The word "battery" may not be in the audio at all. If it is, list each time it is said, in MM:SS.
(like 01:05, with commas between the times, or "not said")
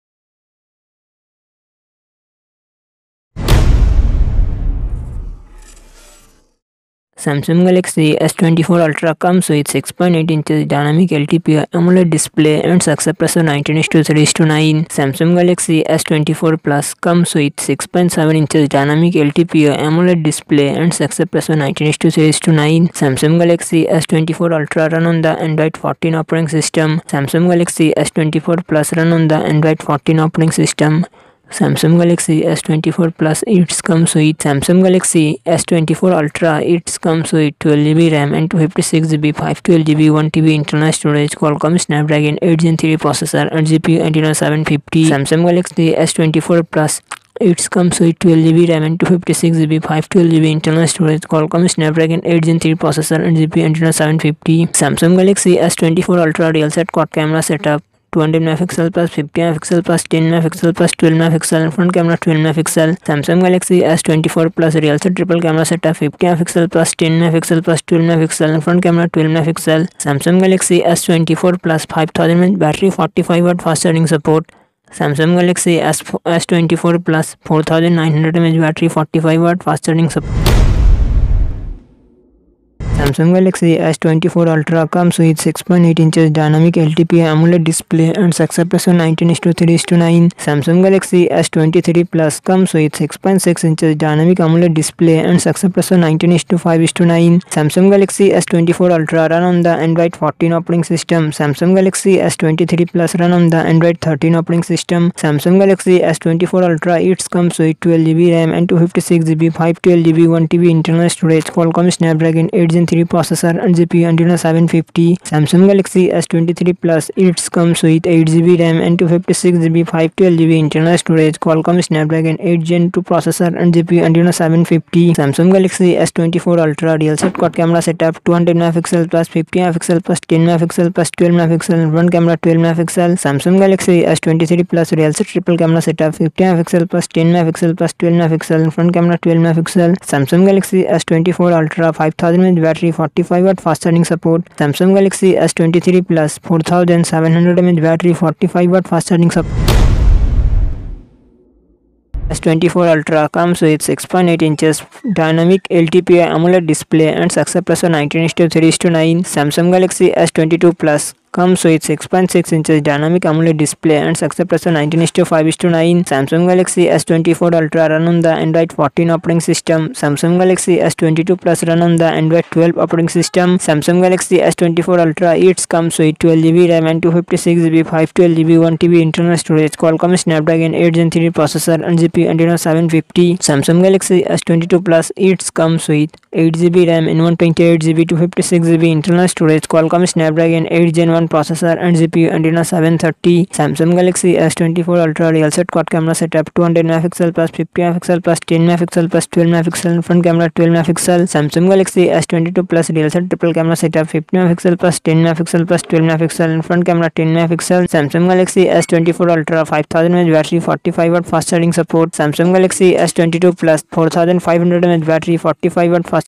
02:22, 02:27, 03:30, 03:35.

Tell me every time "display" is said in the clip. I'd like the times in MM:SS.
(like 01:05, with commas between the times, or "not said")
00:12, 00:20, 01:27, 01:34, 02:36, 02:43.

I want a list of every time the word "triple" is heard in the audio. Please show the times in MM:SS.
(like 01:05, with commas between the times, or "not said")
02:15, 03:23.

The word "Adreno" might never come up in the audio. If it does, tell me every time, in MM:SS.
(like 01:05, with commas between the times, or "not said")
00:44, 00:53, 03:02.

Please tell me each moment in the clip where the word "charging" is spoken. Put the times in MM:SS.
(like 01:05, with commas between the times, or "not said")
02:23, 02:29, 03:31.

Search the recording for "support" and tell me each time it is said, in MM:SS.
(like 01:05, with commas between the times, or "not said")
02:24, 02:29, 03:31.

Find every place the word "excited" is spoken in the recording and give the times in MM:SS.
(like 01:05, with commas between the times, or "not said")
not said.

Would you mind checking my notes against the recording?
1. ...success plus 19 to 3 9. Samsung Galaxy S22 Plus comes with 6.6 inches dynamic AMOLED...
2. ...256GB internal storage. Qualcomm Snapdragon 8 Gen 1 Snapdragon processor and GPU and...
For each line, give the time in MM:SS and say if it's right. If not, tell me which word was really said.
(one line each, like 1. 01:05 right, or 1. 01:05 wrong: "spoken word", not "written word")
1. 02:37 right
2. 03:08 right.